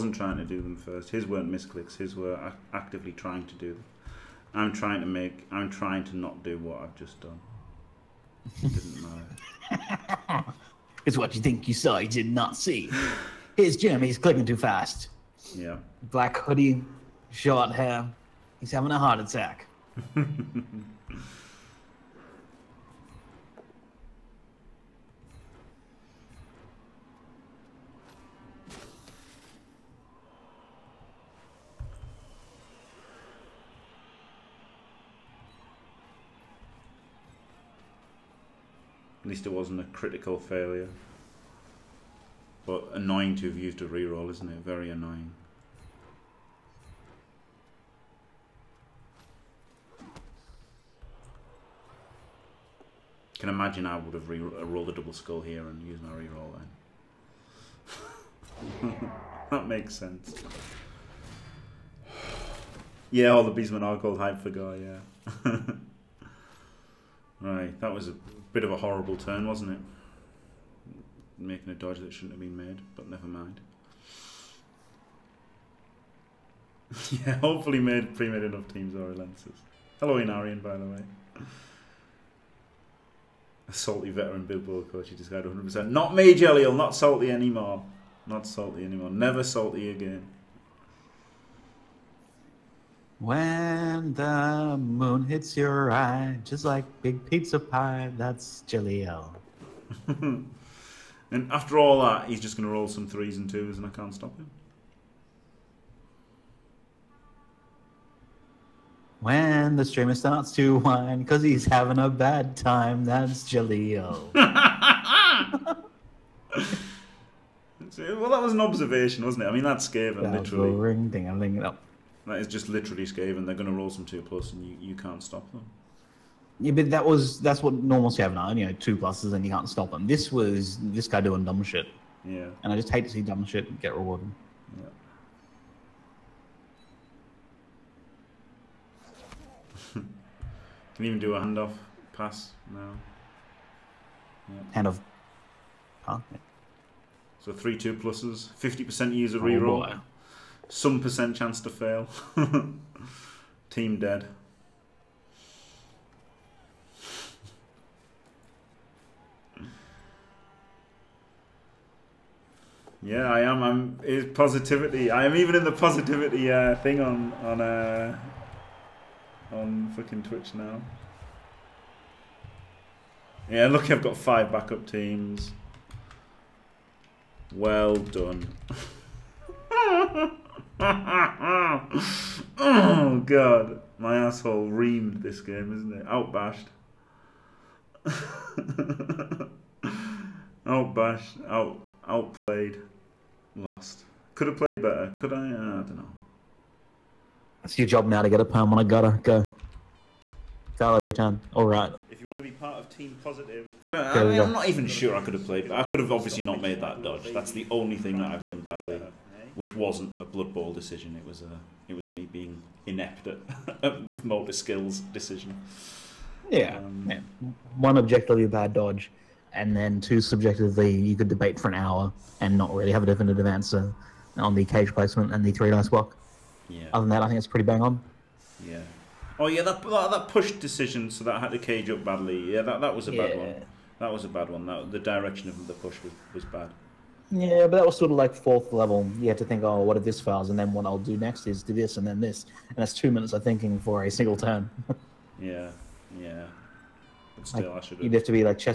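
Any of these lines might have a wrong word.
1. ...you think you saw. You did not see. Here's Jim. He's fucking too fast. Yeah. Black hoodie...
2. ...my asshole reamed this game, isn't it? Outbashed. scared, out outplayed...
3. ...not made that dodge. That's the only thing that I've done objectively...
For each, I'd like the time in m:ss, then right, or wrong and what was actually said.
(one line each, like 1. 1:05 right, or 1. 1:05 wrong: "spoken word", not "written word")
1. 0:11 wrong: "clicking", not "fucking"
2. 3:03 wrong: "outbashed", not "scared"
3. 3:26 wrong: "badly", not "objectively".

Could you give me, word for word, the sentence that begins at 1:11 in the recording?
Making a dodge that shouldn't have been made, but never mind.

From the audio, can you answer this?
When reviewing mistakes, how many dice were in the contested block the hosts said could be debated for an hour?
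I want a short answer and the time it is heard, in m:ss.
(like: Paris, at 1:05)
3, at 3:45.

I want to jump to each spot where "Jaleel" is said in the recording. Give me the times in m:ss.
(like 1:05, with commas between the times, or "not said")
1:38, 1:53.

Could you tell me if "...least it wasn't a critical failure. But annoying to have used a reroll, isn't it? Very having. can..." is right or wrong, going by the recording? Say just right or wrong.
wrong.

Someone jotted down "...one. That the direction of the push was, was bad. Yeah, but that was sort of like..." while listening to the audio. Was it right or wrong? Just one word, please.
right.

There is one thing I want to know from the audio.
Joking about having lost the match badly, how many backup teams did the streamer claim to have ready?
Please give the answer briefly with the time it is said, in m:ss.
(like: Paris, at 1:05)
5, at 2:54.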